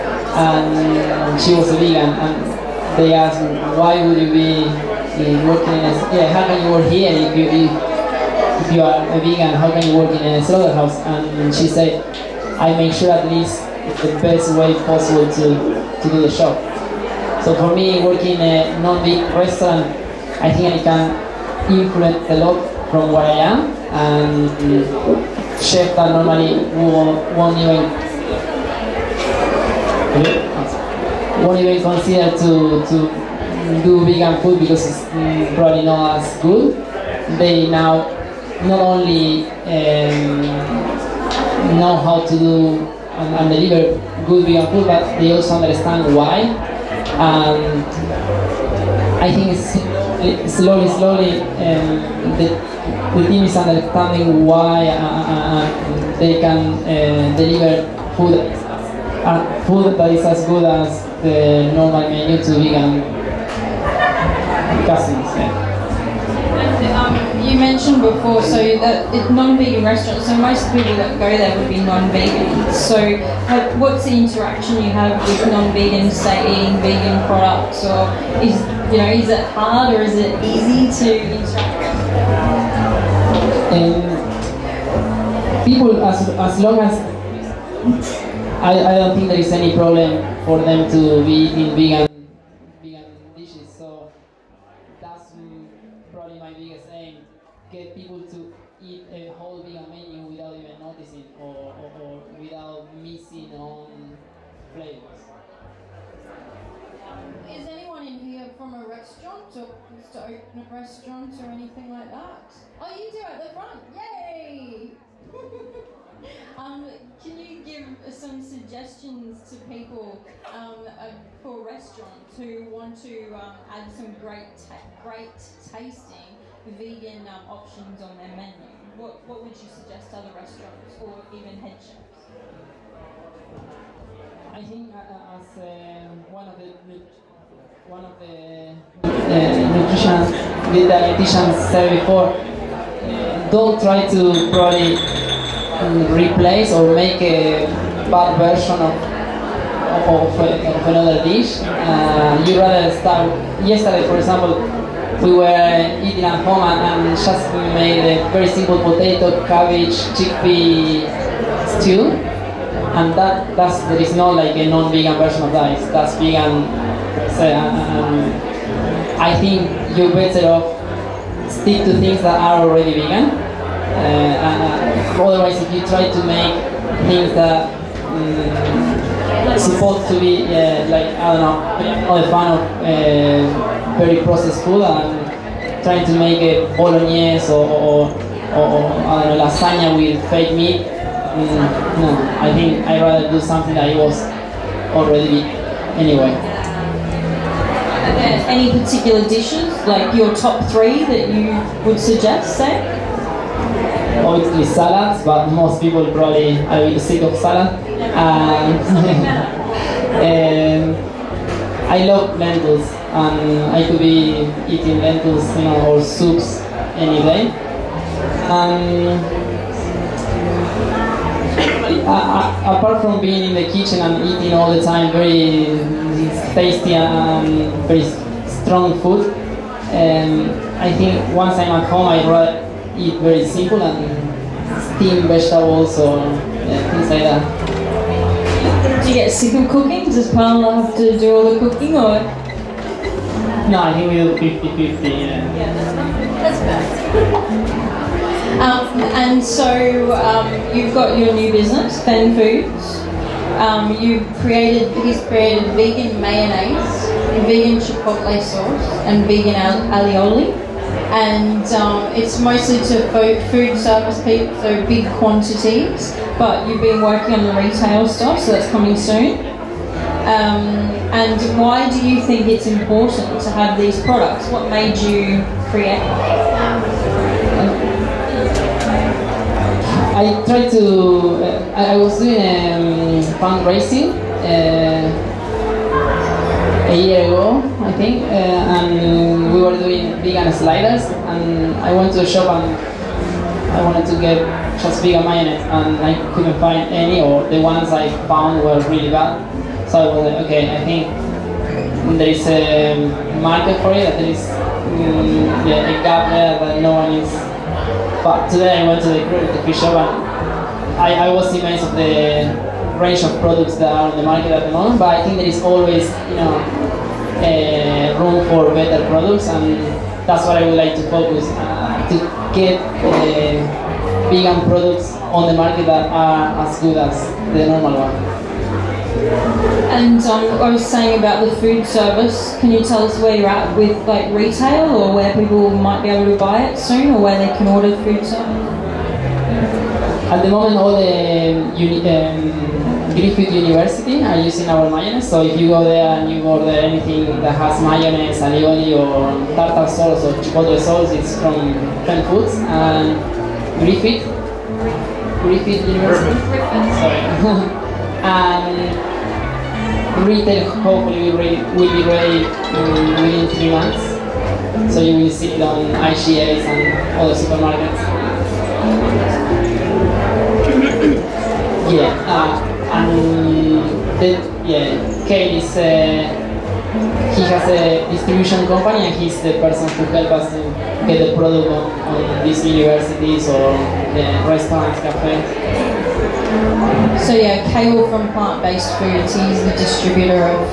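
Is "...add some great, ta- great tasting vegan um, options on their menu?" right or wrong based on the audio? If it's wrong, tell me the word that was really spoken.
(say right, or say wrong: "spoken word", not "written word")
right.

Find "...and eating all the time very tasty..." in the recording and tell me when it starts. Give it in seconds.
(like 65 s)
224 s.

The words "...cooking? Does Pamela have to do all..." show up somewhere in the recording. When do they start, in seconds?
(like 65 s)
239 s.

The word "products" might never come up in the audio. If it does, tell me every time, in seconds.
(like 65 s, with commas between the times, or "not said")
77 s, 274 s, 313 s, 319 s, 324 s, 381 s.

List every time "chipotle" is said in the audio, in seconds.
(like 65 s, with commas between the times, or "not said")
257 s, 350 s.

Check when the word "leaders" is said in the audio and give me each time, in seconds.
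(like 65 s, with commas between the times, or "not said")
not said.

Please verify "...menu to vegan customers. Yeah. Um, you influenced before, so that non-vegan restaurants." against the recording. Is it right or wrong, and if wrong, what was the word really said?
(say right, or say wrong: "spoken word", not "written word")
wrong: "mentioned", not "influenced".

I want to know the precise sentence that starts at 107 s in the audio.
Is anyone in here from a restaurant or wants to open a restaurant or anything like that?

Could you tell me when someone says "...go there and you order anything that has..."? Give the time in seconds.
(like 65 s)
345 s.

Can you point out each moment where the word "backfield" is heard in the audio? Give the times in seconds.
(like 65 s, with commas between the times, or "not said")
not said.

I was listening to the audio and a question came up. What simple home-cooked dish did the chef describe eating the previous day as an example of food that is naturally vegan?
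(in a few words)
potato, cabbage, chickpea stew.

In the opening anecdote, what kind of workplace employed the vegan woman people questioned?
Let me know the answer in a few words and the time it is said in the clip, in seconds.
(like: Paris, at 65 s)
slaughterhouse, at 10 s.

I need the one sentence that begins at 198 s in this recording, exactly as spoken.
Uh, any particular dishes, like your top three that you would suggest, say?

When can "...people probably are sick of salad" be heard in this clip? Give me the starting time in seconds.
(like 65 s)
205 s.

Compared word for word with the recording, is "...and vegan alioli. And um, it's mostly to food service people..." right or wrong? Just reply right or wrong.
right.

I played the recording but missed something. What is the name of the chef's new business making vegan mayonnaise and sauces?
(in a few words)
Fenn Foods.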